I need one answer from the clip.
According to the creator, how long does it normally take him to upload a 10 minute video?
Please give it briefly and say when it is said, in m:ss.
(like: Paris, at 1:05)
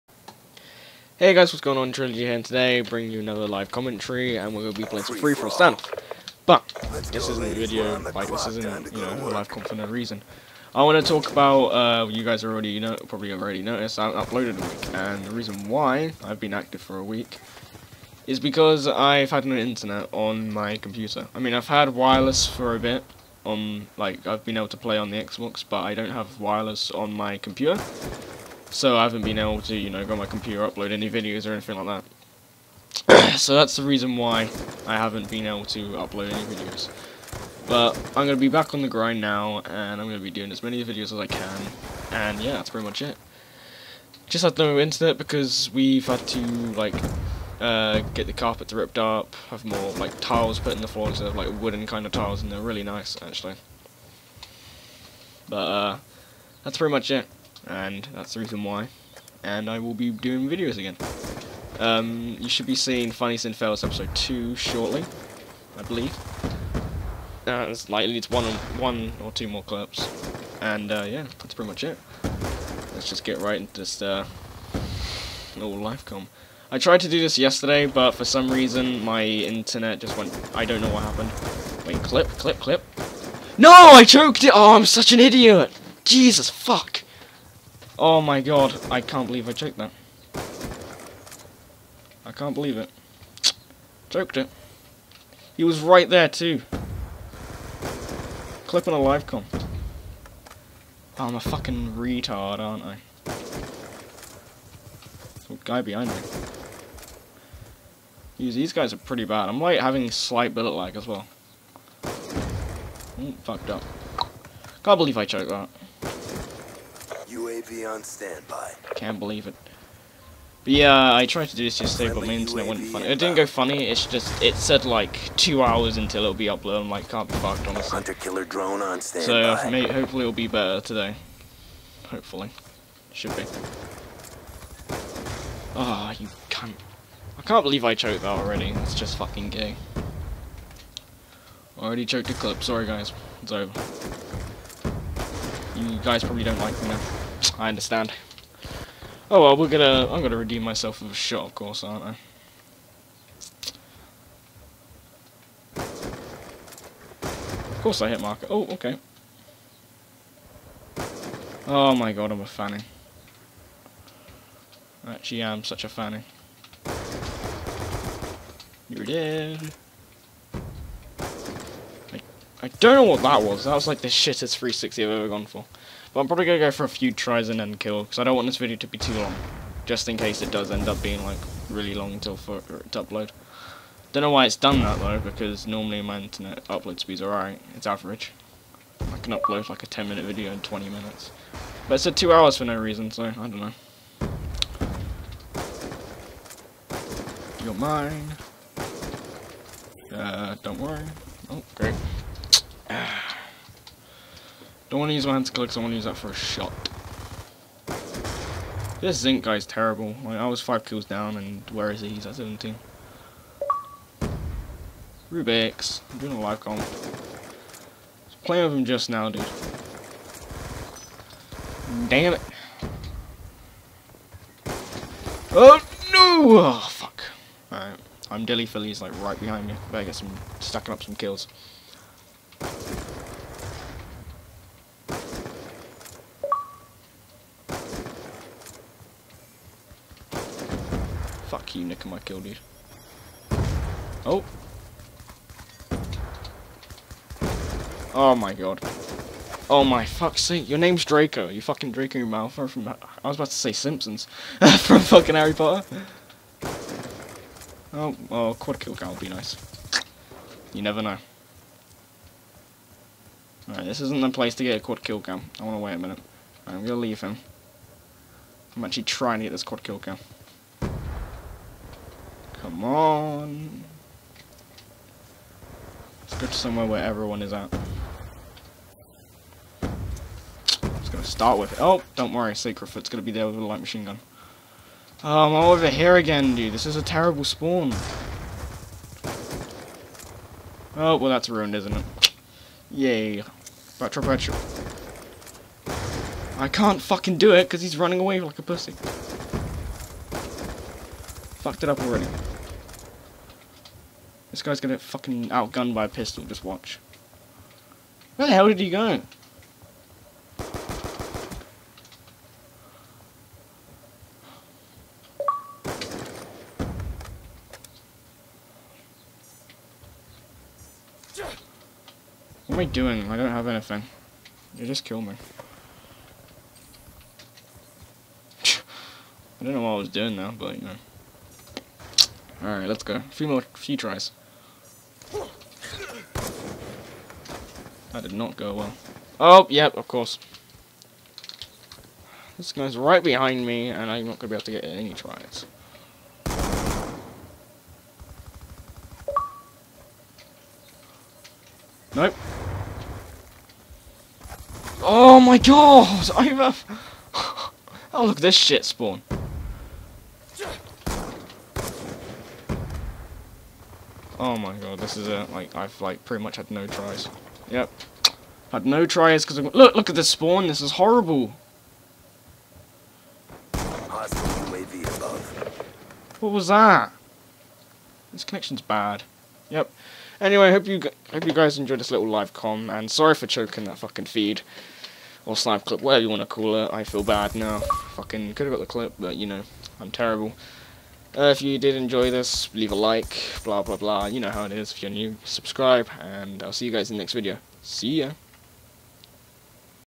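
20 minutes, at 3:10.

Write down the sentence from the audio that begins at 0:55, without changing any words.
But, uh, that's pretty much it and that's the reason why.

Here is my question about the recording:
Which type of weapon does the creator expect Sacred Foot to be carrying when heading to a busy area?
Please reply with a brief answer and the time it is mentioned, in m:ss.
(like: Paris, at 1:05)
light machine gun, at 4:43.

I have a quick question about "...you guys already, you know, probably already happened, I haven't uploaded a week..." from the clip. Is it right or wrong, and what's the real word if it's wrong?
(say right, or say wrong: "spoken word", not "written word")
wrong: "noticed", not "happened".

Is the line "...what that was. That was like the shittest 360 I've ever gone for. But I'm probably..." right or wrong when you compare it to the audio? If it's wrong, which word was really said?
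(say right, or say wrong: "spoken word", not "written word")
right.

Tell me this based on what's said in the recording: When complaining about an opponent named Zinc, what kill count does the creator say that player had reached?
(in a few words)
17.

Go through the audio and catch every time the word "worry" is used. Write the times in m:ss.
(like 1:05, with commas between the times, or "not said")
3:20, 4:42.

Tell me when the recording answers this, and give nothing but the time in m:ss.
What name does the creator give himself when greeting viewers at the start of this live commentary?
0:01.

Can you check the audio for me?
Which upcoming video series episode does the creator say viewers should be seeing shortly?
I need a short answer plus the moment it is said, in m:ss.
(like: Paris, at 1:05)
Funny Sin Fails episode 2, at 1:03.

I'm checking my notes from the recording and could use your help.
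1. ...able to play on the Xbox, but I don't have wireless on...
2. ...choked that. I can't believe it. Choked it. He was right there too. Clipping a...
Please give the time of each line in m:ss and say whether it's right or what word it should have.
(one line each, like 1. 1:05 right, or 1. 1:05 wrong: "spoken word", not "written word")
1. 0:24 right
2. 1:29 right.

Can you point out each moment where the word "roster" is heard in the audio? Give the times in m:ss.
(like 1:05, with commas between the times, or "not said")
not said.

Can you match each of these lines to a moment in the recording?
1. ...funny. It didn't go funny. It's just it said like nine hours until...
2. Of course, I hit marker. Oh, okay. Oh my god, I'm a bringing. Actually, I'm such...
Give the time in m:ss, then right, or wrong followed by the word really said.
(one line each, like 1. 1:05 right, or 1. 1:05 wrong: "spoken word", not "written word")
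1. 2:02 wrong: "two", not "nine"
2. 2:35 wrong: "fanning", not "bringing".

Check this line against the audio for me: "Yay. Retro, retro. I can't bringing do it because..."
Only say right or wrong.
wrong.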